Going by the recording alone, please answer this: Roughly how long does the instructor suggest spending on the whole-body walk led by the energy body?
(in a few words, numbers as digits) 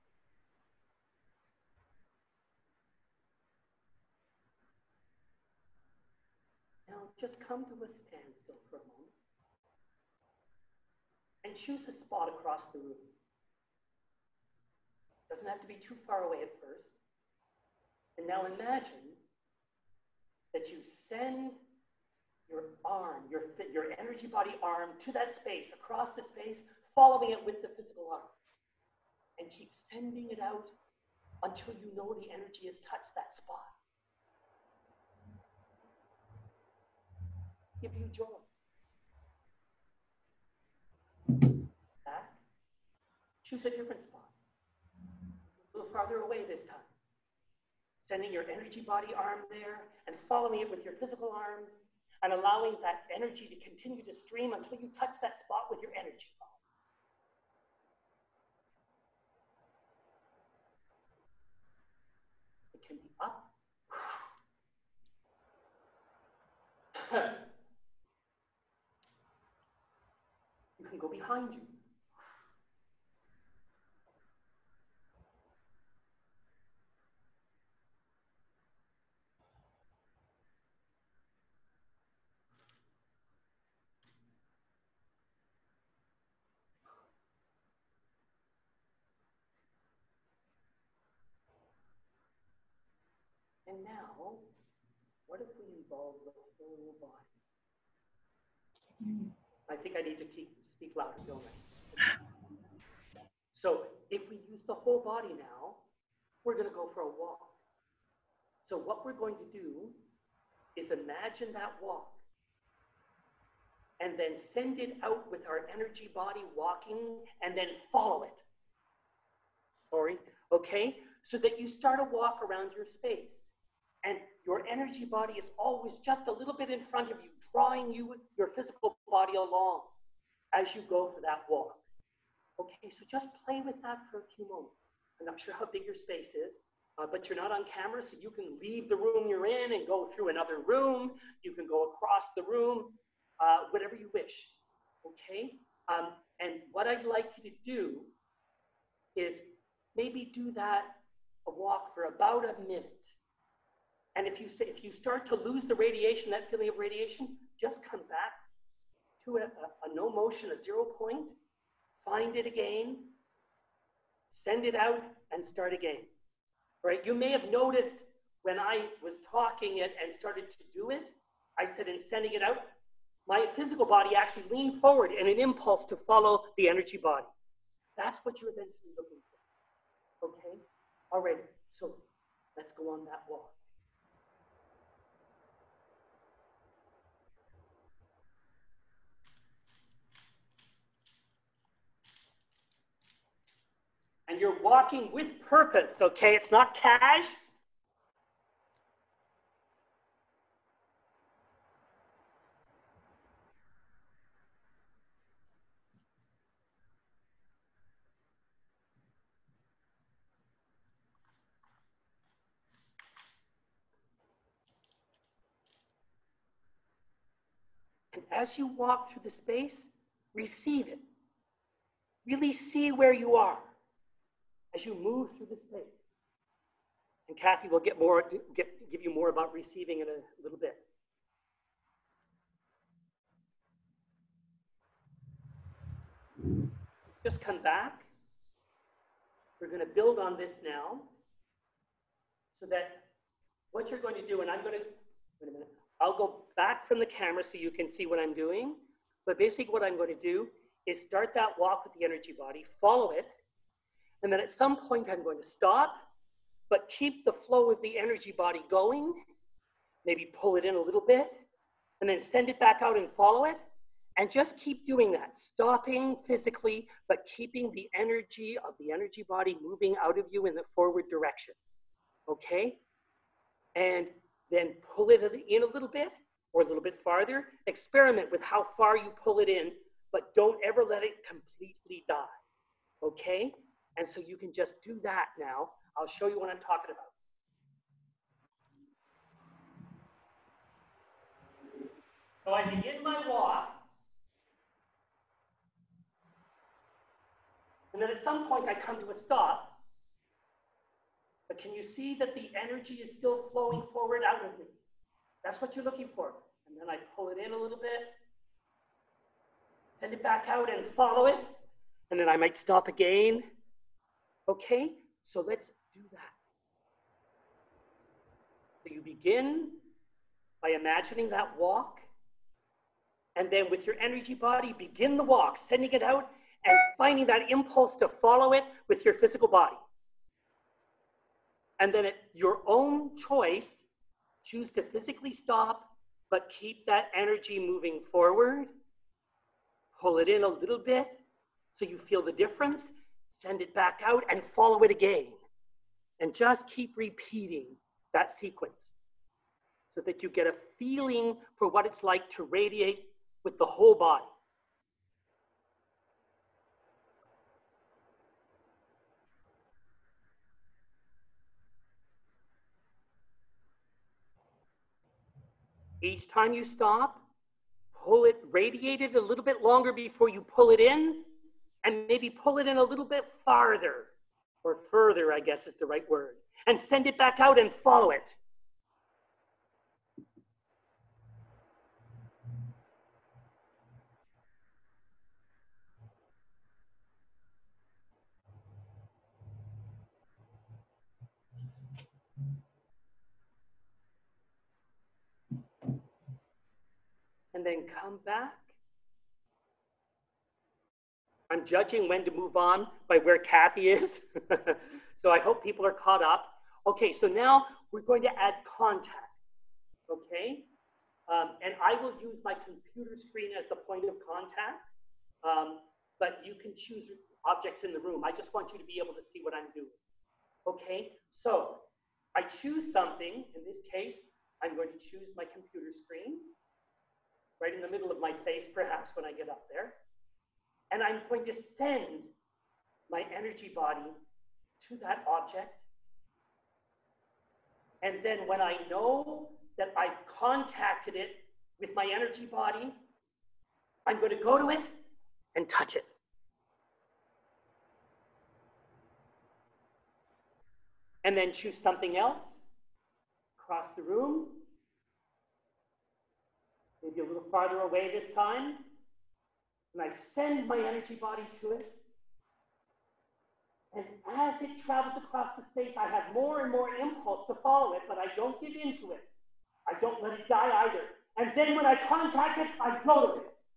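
about a minute.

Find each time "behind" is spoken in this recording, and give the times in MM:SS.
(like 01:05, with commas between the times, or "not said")
01:11.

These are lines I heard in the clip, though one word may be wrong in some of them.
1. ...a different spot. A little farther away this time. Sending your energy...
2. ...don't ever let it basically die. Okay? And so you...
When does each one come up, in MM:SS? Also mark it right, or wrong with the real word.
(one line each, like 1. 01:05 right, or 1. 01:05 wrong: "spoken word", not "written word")
1. 00:43 right
2. 04:40 wrong: "completely", not "basically".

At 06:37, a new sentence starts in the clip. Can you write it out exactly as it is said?
and then come back I'm judging when to move on by where Kathy is.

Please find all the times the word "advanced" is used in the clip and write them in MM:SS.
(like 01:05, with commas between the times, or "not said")
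not said.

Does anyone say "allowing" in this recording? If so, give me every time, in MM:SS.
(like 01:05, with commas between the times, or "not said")
00:52.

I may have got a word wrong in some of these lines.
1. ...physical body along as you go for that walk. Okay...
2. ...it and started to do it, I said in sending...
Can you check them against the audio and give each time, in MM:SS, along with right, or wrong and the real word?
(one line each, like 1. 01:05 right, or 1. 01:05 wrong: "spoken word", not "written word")
1. 02:08 right
2. 02:49 right.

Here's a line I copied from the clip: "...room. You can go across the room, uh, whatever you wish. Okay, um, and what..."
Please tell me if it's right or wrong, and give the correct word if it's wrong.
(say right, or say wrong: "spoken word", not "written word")
right.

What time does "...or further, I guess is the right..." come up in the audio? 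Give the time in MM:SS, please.
06:14.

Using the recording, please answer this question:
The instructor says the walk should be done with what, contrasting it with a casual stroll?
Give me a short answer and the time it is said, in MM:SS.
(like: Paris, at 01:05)
purpose, at 03:15.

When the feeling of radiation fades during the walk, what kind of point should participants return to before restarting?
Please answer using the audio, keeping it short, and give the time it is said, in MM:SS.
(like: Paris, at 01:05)
zero point, at 02:40.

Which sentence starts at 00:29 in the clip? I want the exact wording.
And keep sending it out until you know the energy has touched that spot.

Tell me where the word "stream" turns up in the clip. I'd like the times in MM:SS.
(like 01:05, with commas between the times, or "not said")
00:54.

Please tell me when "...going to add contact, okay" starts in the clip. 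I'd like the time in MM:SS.
06:48.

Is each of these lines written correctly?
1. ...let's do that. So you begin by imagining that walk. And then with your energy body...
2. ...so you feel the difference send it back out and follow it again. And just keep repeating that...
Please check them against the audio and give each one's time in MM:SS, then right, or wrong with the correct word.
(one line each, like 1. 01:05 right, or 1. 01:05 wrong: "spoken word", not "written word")
1. 05:15 right
2. 05:41 right.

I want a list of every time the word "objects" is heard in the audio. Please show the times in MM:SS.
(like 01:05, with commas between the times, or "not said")
06:57, 07:15.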